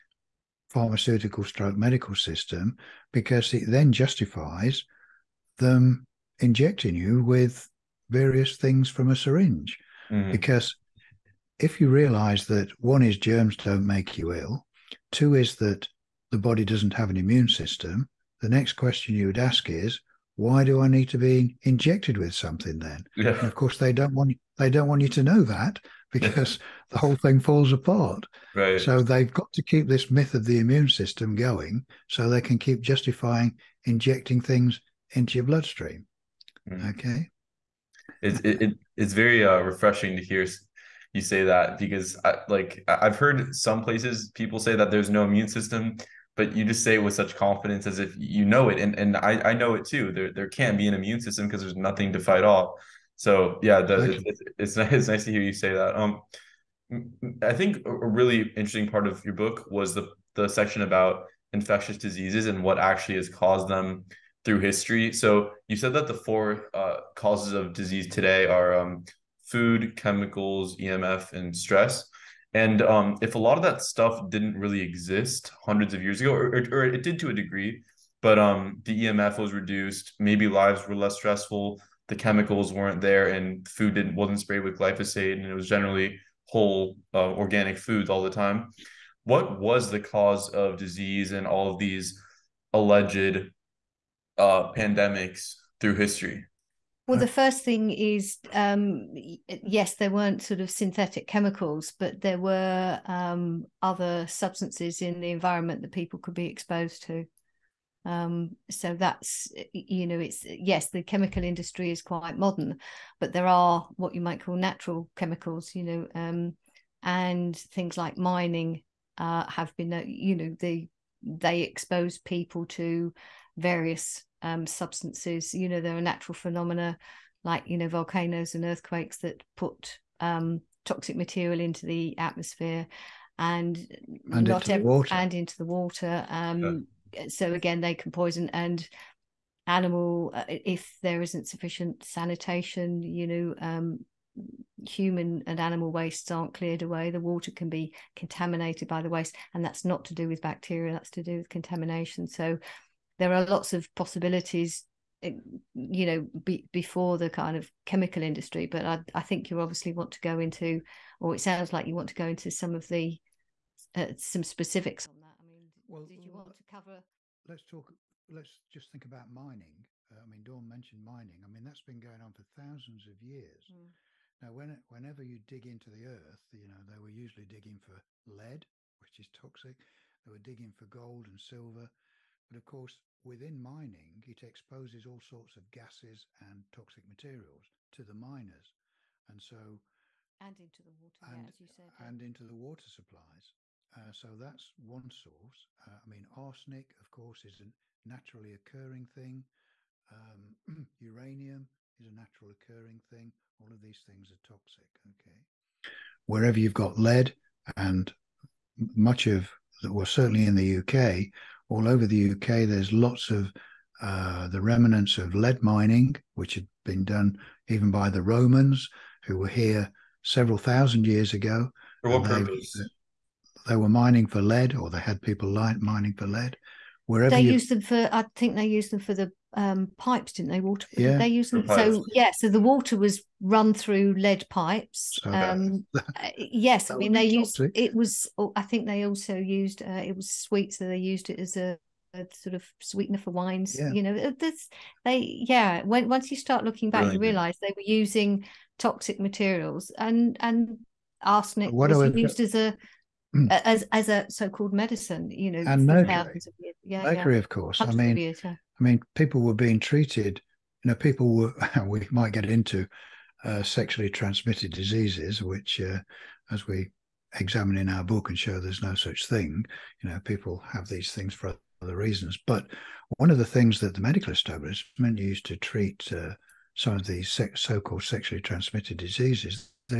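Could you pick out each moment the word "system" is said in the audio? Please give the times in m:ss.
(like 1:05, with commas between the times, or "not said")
0:02, 0:17, 0:30, 0:45, 0:51.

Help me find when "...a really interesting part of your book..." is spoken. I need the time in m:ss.
0:57.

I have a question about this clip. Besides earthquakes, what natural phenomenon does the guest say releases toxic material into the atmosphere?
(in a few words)
volcanoes.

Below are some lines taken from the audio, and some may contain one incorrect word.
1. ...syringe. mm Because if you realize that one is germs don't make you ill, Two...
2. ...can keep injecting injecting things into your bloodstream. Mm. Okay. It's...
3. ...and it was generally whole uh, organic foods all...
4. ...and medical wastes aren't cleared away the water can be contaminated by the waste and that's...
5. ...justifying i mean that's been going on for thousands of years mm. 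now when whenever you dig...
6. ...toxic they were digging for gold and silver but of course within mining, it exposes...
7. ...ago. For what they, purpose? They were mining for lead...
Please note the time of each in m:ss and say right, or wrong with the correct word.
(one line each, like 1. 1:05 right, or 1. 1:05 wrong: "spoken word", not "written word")
1. 0:09 right
2. 0:32 wrong: "justifying", not "injecting"
3. 1:25 right
4. 2:25 wrong: "animal", not "medical"
5. 2:51 wrong: "mining", not "justifying"
6. 2:59 right
7. 3:41 right.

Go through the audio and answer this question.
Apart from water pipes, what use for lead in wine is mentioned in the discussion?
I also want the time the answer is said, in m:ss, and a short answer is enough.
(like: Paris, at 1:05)
sweetener, at 4:02.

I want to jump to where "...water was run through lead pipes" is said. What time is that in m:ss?
3:52.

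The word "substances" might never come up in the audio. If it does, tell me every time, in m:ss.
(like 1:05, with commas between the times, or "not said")
1:44, 2:04.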